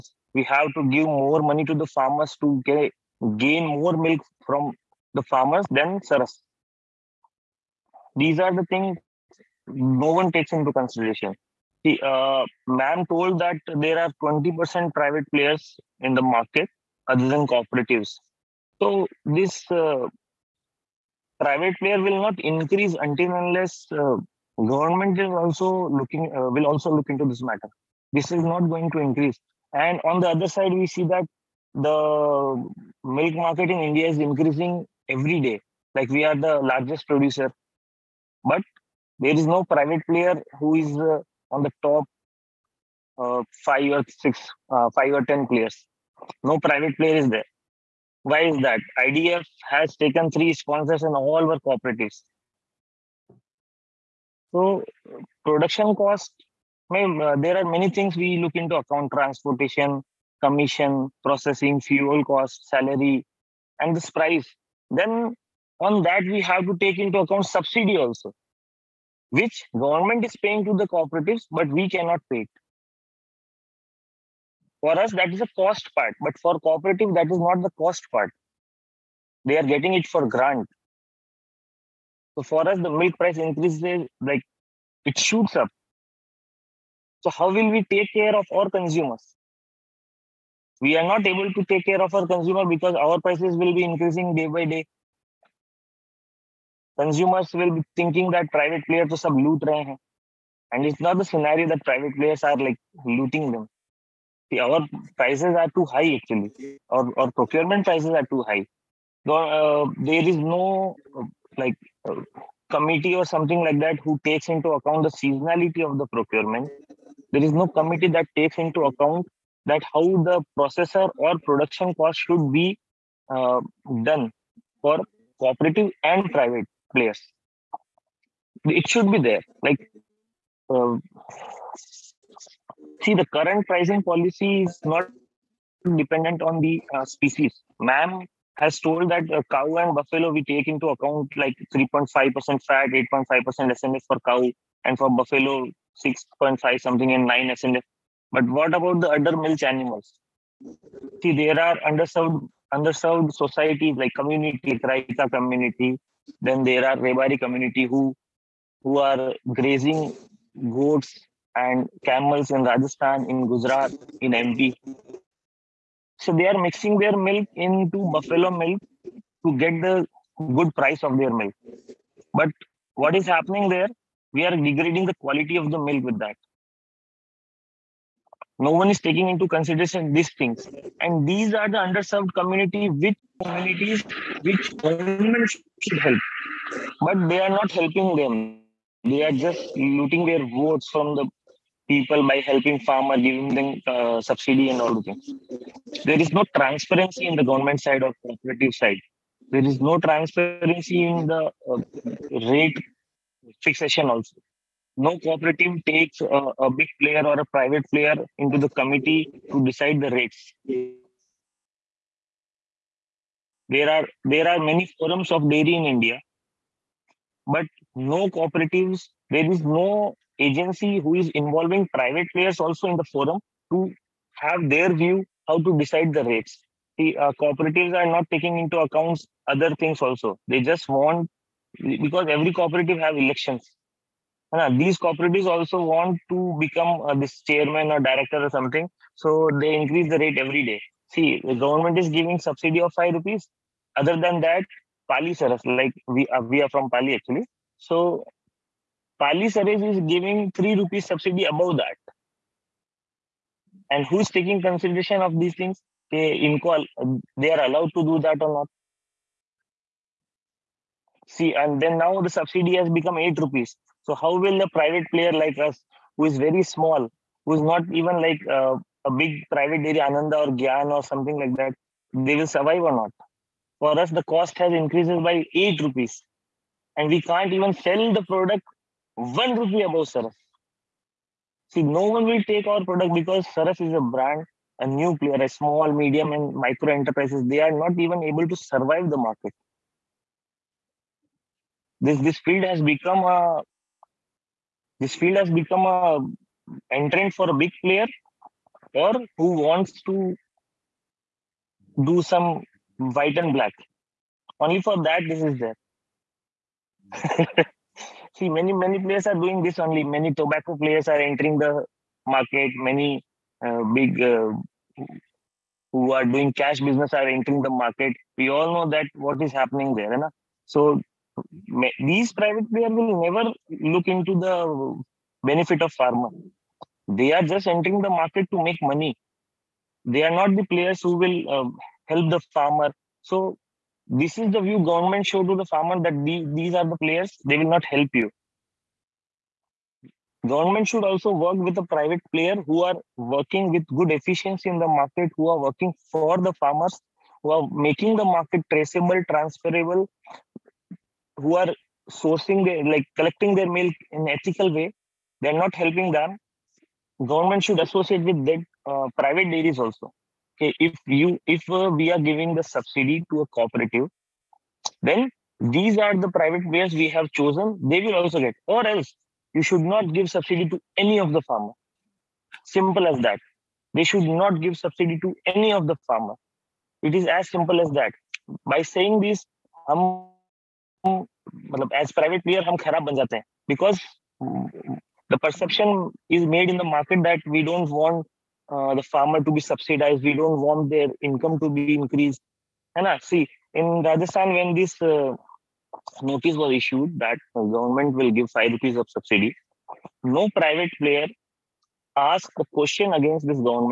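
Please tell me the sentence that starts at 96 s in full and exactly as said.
Consumers will be thinking that private players are sub loot rahe hain.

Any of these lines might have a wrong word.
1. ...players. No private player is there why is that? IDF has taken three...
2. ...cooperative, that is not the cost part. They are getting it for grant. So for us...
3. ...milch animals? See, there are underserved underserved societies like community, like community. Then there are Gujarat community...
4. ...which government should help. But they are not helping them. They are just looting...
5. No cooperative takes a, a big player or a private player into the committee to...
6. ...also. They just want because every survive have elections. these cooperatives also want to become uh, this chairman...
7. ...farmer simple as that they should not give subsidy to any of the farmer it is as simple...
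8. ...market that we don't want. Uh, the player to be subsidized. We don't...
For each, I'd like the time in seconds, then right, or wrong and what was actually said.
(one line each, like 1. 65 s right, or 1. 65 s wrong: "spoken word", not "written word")
1. 45 s right
2. 76 s right
3. 149 s wrong: "Rebari", not "Gujarat"
4. 184 s right
5. 205 s right
6. 230 s wrong: "cooperative", not "survive"
7. 371 s right
8. 386 s wrong: "farmer", not "player".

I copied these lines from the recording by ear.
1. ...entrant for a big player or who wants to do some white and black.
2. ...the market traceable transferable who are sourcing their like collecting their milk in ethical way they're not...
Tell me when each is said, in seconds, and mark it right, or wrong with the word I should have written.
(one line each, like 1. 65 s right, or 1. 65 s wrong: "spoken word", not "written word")
1. 296 s right
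2. 348 s right.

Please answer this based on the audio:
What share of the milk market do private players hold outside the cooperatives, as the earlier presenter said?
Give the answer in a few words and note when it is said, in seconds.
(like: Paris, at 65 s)
20%, at 14 s.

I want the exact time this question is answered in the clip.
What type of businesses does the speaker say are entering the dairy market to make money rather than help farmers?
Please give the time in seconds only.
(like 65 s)
310 s.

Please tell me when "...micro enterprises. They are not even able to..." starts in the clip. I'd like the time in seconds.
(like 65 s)
286 s.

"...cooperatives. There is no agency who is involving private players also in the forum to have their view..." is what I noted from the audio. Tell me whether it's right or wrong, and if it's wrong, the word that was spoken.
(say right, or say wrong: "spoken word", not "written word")
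right.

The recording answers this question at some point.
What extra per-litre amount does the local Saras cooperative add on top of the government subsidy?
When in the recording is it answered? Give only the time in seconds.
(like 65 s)
250 s.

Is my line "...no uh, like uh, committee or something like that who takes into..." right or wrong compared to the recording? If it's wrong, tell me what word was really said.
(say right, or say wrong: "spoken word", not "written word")
right.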